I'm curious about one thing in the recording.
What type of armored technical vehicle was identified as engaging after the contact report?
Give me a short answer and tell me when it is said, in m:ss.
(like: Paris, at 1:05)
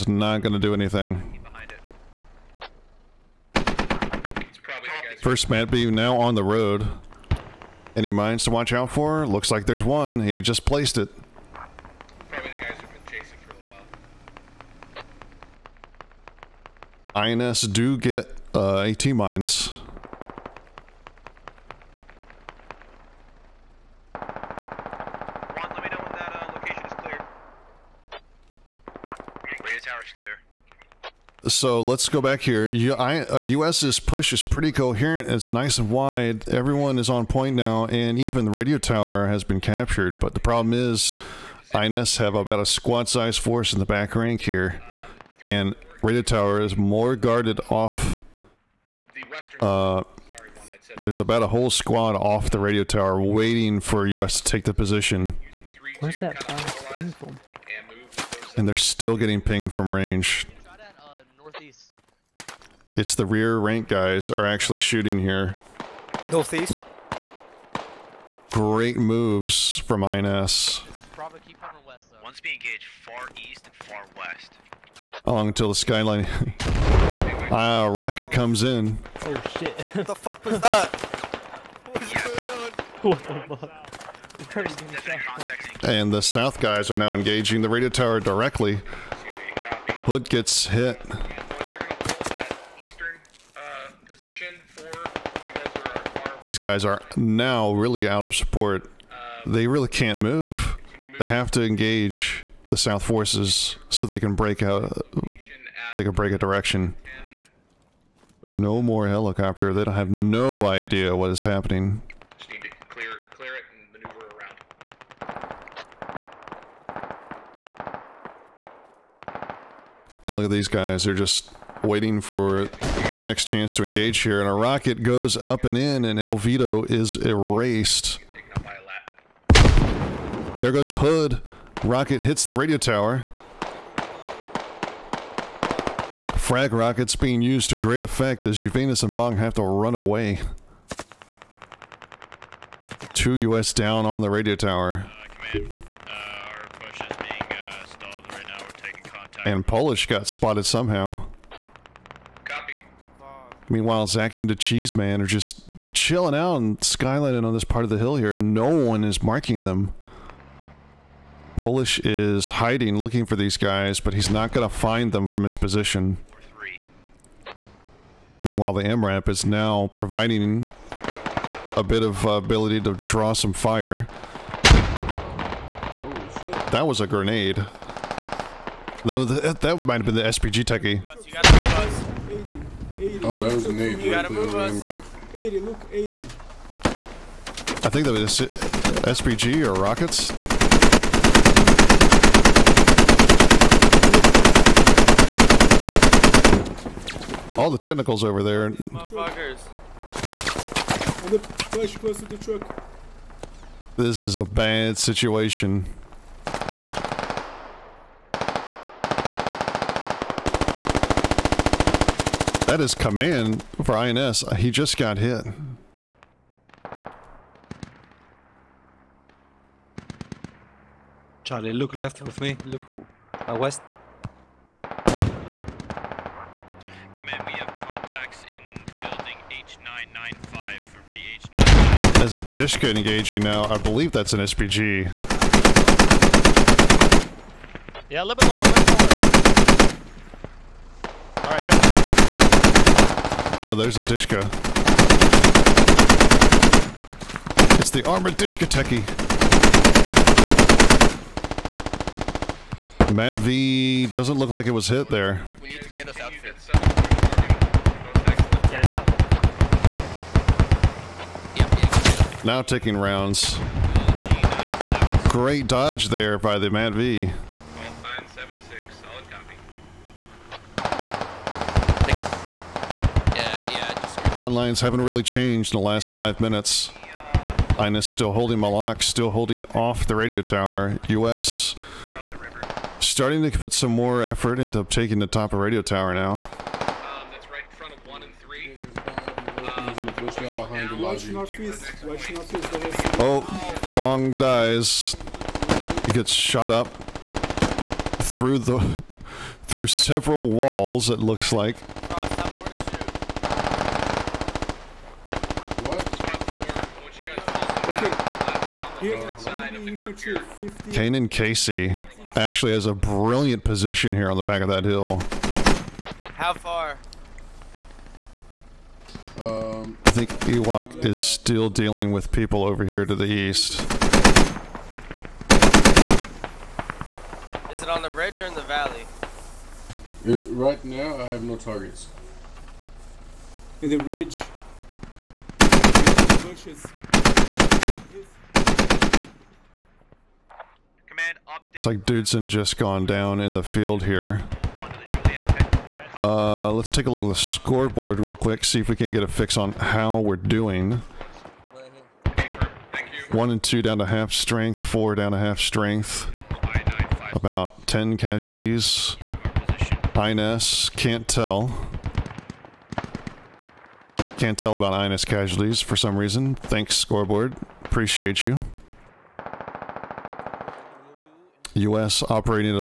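armored Dishka Techie, at 4:08.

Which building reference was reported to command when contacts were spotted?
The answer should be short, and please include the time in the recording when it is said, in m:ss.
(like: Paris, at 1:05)
H995, at 3:49.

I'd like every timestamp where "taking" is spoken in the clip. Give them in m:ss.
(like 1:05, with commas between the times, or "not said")
4:22, 4:44.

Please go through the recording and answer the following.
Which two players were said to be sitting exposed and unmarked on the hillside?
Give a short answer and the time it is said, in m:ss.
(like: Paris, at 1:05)
Zachy and the Cheese Man, at 2:34.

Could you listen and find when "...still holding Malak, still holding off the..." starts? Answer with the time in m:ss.
4:38.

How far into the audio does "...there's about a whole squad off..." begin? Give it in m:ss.
0:51.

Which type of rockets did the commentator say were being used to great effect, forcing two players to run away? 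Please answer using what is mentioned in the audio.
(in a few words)
Frag rockets.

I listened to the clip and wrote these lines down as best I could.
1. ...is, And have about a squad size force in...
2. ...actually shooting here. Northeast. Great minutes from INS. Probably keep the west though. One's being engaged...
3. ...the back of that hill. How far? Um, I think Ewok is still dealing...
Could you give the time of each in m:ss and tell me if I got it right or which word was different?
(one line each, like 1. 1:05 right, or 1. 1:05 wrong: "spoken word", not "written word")
1. 0:40 wrong: "INS", not "And"
2. 1:04 wrong: "moves", not "minutes"
3. 5:14 right.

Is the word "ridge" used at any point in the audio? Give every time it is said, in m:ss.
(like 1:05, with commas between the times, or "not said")
5:28, 5:33.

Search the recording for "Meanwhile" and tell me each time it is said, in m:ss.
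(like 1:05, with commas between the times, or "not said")
2:33, 2:48.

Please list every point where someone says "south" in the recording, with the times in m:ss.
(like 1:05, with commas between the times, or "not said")
1:26, 1:42.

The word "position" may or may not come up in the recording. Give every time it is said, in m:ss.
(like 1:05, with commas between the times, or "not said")
0:54, 2:45, 5:13.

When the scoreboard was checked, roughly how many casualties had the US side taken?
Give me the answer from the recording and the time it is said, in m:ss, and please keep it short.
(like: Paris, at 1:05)
10, at 5:57.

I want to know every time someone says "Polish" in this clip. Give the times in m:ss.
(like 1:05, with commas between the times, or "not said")
2:29, 2:41.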